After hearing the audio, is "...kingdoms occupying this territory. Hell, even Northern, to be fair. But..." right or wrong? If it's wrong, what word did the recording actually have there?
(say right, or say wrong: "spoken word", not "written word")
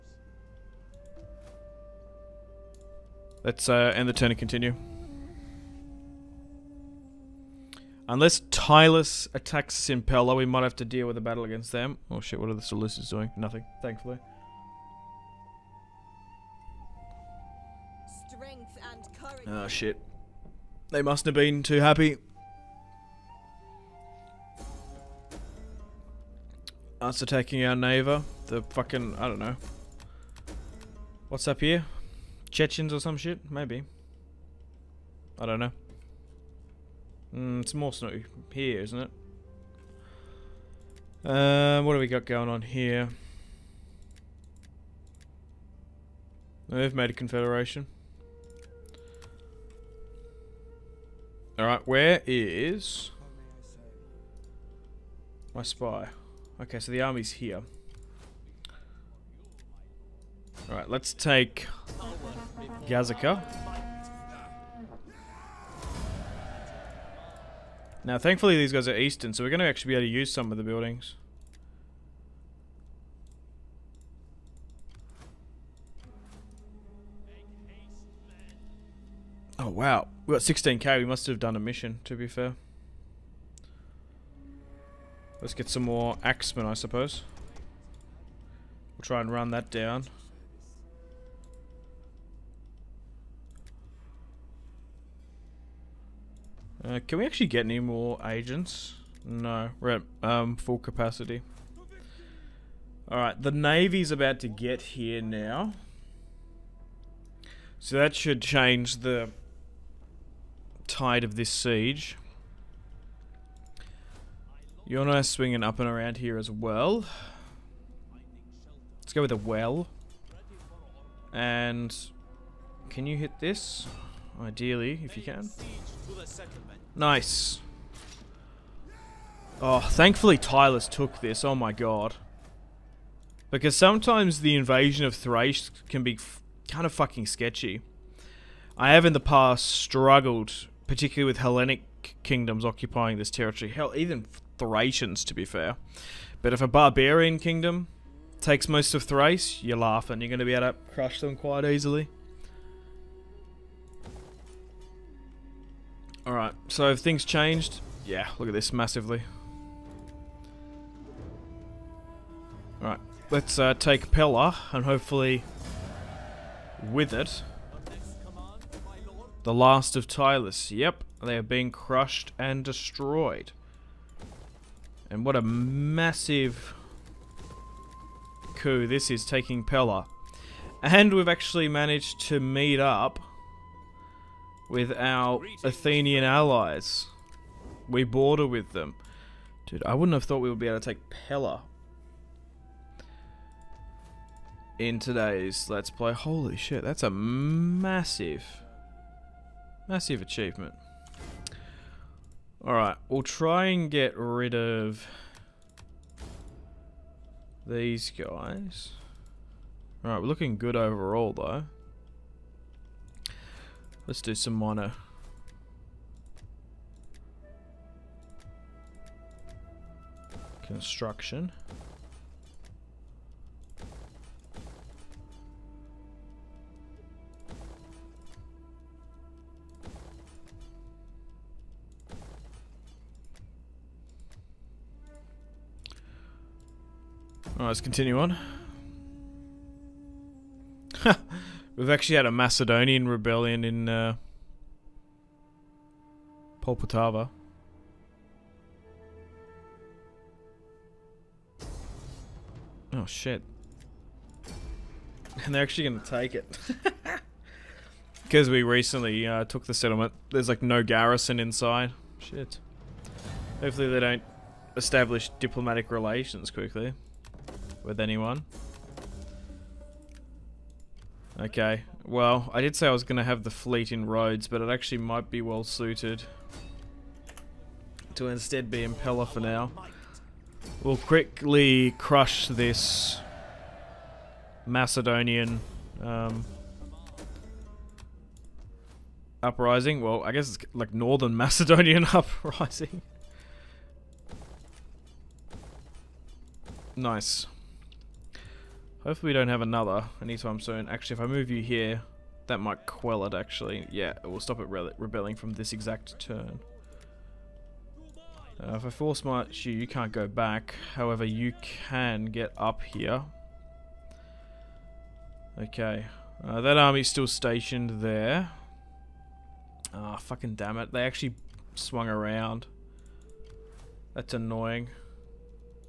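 wrong: "Thracians", not "Northern".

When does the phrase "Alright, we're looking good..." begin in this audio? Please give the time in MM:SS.
03:30.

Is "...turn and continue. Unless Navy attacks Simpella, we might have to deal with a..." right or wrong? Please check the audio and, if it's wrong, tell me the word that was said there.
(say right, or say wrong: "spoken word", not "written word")
wrong: "Tylis", not "Navy".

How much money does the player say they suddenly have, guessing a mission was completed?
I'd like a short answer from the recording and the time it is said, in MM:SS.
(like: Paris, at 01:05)
16k, at 01:20.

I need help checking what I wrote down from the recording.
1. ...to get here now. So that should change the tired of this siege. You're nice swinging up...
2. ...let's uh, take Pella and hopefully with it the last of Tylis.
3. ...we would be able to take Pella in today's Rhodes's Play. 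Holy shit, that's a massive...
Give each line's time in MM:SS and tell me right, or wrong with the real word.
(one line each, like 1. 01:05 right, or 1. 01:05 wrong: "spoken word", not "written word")
1. 01:44 right
2. 02:43 right
3. 03:10 wrong: "Let", not "Rhodes".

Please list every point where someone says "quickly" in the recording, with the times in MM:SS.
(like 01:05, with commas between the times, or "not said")
04:26, 04:40.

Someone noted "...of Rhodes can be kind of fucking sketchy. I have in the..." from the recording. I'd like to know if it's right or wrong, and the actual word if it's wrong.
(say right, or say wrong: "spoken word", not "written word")
wrong: "Thrace", not "Rhodes".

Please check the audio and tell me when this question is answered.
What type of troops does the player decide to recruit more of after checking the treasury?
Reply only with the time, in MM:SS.
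01:26.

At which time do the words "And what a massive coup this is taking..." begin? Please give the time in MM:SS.
02:55.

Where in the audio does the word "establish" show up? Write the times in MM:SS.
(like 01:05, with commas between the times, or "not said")
04:24.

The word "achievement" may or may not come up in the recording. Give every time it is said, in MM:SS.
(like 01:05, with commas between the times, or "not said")
03:20.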